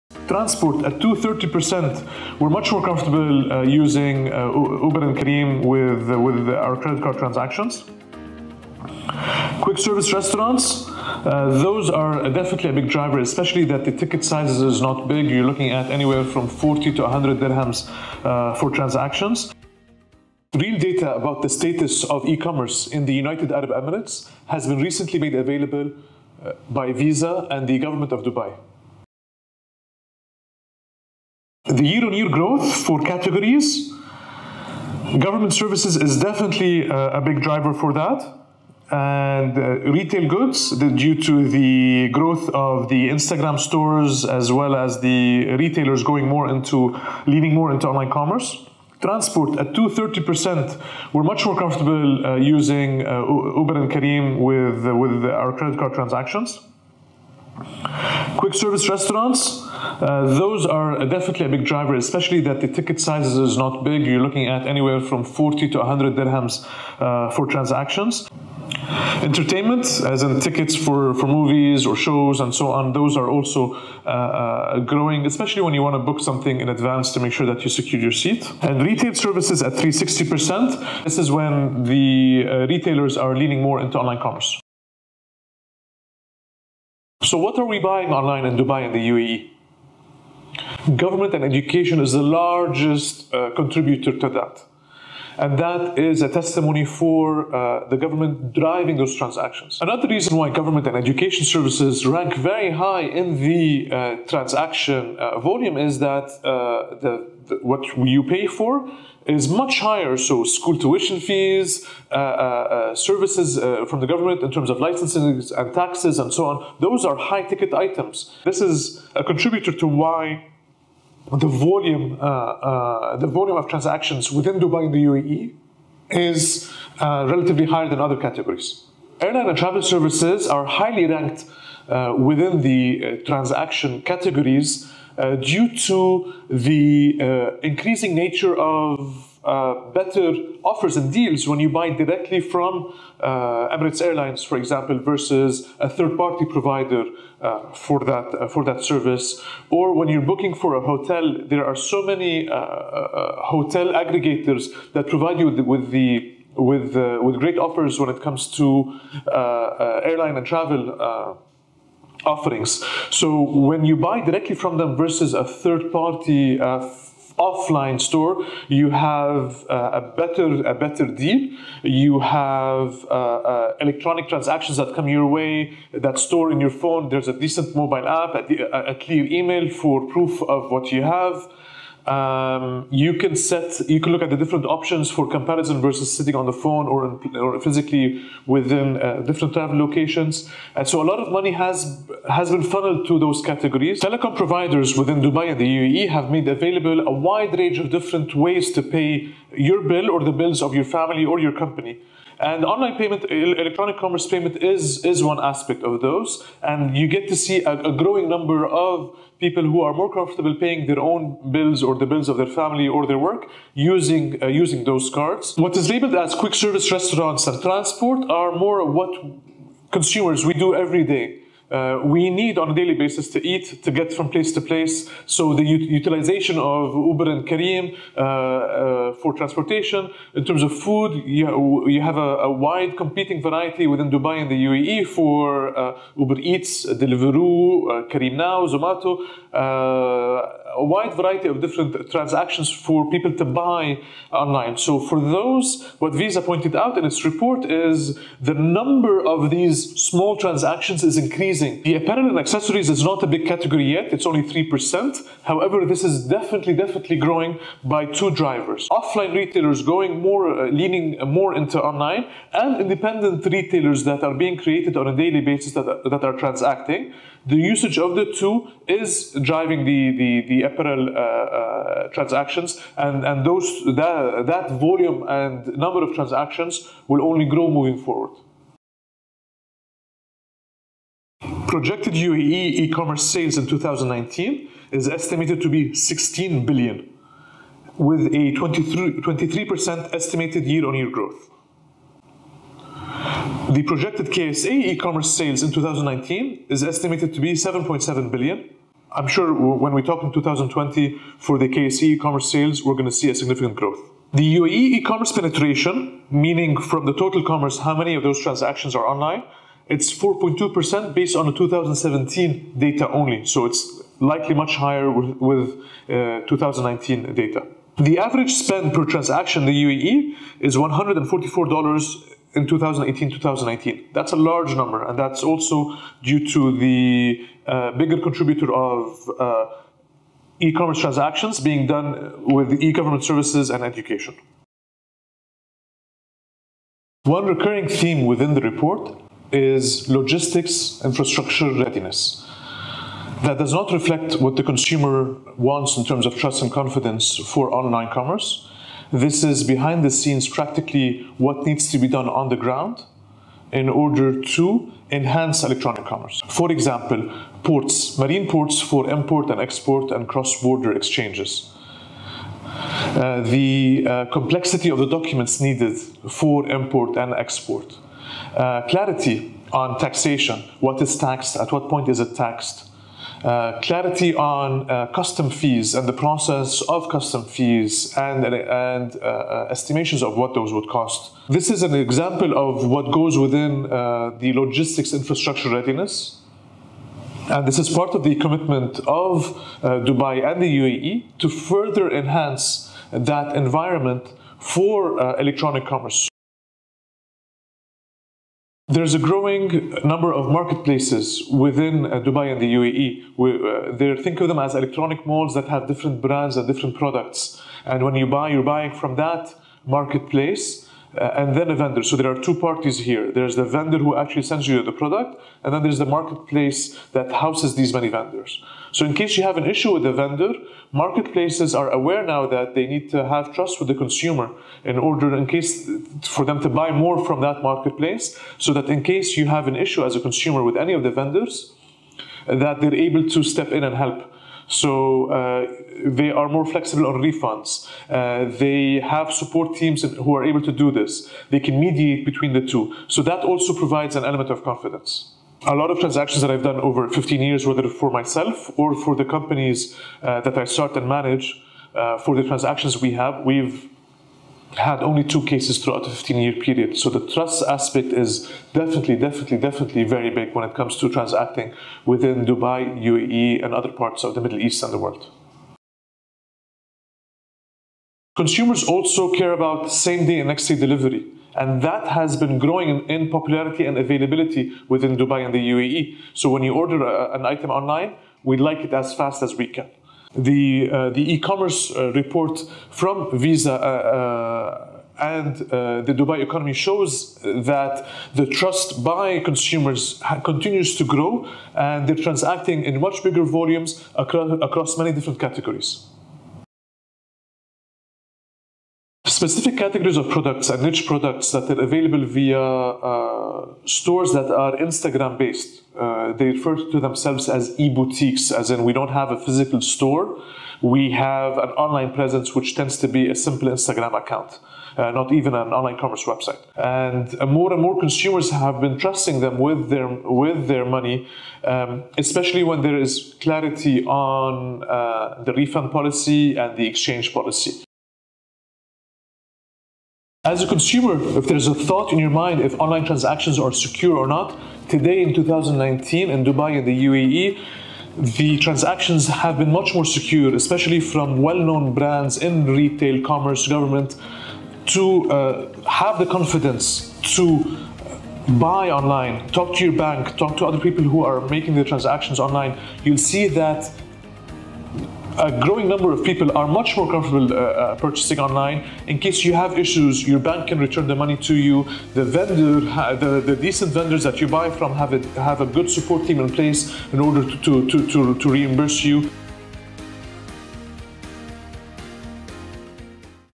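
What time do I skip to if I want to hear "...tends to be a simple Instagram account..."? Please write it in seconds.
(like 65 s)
512 s.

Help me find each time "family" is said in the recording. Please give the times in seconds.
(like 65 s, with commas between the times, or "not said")
200 s, 212 s.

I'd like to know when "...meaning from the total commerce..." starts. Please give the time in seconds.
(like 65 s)
306 s.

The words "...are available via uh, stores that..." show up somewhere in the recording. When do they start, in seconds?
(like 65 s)
501 s.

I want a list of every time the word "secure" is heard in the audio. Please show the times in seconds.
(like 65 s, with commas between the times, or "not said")
77 s, 533 s, 540 s.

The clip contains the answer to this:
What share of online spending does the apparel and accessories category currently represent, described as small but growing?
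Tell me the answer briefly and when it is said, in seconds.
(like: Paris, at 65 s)
3%, at 254 s.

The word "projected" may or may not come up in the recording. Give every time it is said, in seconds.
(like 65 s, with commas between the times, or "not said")
281 s, 293 s.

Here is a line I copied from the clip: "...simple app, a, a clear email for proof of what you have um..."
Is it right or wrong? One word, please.
wrong.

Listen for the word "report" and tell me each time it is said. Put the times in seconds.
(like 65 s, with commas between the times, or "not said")
247 s, 338 s, 482 s.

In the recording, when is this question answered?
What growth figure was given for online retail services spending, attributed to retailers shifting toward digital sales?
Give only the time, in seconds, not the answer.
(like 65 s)
79 s.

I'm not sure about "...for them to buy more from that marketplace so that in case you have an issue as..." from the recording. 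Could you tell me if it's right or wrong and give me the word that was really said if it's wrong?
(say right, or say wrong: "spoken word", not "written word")
right.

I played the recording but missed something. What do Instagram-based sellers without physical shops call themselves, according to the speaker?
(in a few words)
e boutiques.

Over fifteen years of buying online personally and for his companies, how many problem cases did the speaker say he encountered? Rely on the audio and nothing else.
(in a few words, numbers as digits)
2.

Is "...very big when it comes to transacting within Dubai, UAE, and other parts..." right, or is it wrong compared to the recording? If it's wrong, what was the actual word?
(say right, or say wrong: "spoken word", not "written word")
right.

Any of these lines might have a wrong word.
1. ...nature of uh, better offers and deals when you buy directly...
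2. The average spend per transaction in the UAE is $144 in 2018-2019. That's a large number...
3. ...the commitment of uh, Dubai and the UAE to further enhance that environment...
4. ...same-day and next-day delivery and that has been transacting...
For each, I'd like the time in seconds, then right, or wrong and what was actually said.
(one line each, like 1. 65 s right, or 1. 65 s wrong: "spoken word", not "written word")
1. 138 s right
2. 317 s right
3. 388 s right
4. 469 s wrong: "growing", not "transacting".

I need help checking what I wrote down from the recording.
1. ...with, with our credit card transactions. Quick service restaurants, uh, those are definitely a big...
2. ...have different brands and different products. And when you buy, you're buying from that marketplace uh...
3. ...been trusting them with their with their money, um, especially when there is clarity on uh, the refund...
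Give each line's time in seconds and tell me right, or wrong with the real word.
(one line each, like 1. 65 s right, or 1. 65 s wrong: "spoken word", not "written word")
1. 54 s right
2. 405 s right
3. 518 s right.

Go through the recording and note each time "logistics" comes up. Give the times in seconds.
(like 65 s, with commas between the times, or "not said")
340 s, 384 s.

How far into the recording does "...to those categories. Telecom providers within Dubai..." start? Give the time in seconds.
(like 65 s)
193 s.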